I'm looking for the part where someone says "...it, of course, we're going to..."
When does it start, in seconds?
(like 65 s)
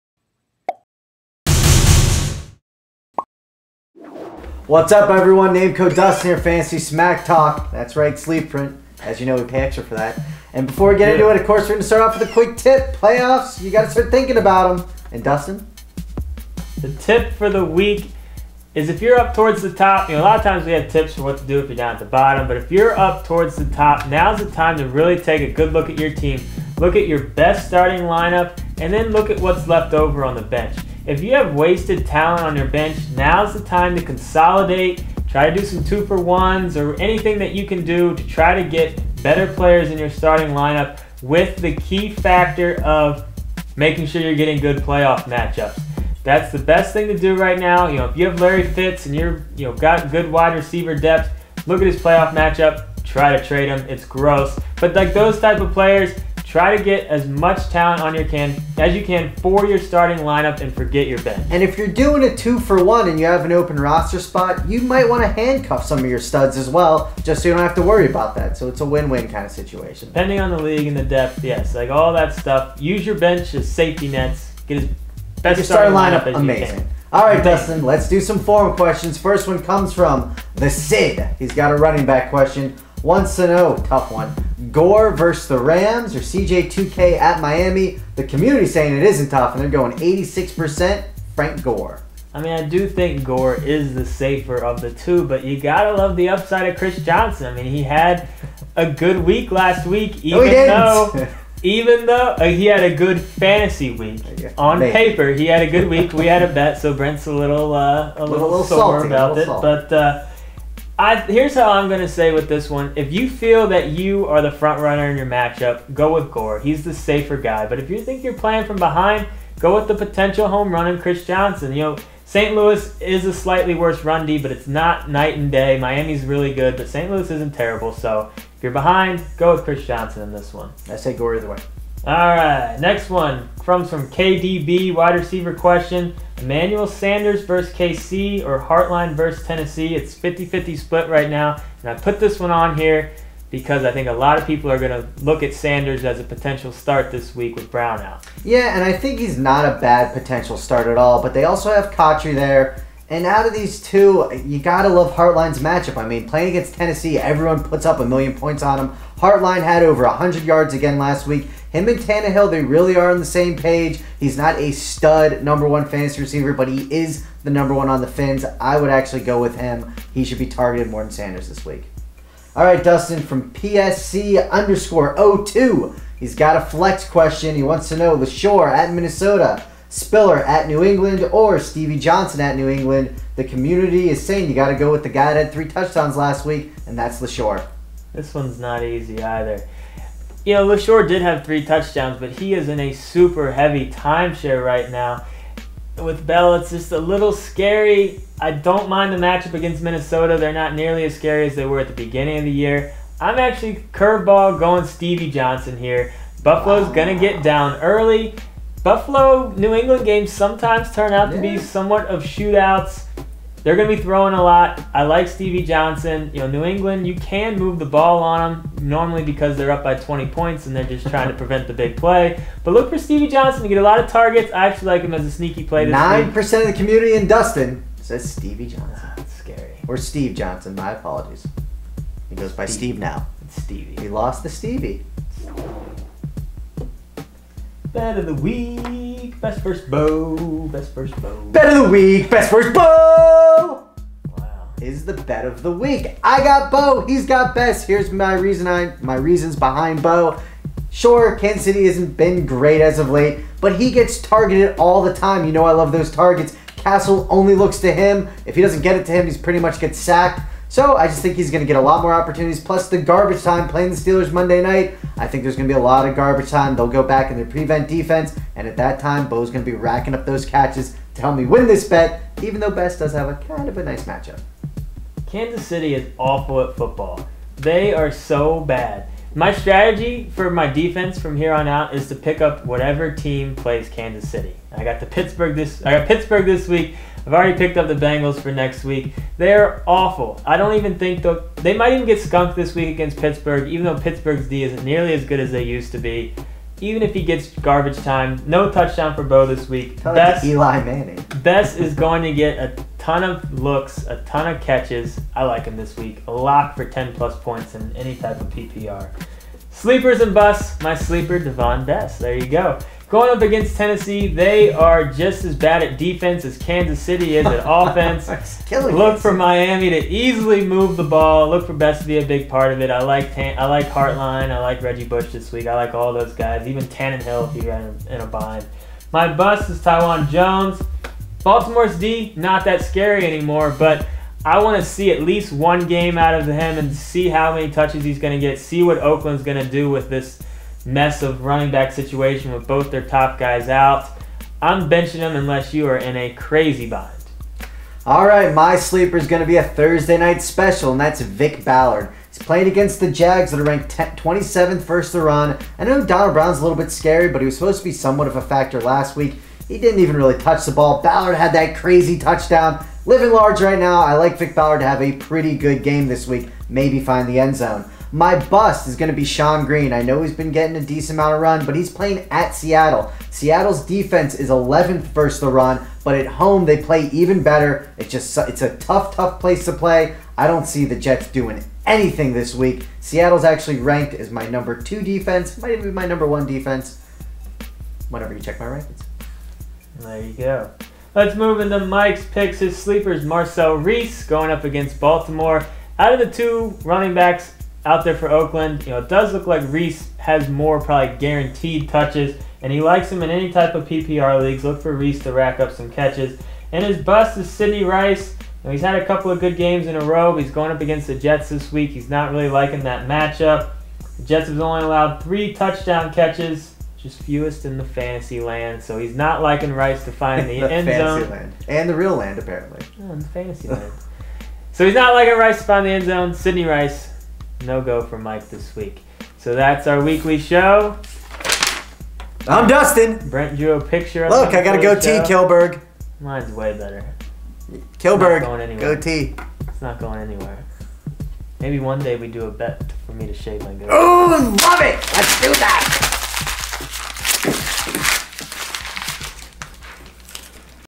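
11 s.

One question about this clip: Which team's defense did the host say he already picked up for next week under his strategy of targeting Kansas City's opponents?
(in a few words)
Bengals.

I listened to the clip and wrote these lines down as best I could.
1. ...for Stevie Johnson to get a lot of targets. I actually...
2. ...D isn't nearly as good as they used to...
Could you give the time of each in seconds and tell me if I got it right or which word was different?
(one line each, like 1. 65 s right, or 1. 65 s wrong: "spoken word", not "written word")
1. 222 s right
2. 294 s right.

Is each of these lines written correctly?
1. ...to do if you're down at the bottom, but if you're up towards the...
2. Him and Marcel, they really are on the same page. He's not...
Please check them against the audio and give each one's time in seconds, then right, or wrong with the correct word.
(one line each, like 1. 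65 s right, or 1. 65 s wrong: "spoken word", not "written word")
1. 21 s right
2. 161 s wrong: "Tannehill", not "Marcel".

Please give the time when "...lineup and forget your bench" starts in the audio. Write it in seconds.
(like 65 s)
60 s.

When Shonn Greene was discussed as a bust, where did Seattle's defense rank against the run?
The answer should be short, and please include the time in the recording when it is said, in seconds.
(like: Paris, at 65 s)
11th, at 374 s.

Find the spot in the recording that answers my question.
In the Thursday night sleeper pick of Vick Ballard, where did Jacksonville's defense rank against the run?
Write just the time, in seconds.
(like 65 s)
353 s.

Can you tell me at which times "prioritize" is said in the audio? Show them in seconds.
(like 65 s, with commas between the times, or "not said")
not said.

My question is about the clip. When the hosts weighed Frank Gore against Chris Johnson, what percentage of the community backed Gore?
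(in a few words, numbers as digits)
86%.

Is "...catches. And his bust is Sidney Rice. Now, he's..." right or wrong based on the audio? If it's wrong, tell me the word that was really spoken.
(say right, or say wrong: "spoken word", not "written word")
right.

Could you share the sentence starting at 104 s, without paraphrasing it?
paper, he had a good week.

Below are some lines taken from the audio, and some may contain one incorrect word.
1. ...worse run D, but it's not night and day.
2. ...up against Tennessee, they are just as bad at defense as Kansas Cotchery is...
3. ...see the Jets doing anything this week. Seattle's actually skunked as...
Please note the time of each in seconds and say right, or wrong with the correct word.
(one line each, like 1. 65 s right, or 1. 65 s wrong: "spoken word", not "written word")
1. 123 s right
2. 313 s wrong: "City", not "Cotchery"
3. 380 s wrong: "ranked", not "skunked".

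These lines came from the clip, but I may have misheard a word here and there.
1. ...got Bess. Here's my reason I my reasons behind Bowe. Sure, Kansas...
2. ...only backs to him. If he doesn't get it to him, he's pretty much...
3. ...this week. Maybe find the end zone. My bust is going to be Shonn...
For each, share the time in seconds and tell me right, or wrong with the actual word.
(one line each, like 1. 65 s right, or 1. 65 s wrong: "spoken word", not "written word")
1. 247 s right
2. 257 s wrong: "looks", not "backs"
3. 366 s right.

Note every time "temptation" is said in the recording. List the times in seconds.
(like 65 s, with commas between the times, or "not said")
not said.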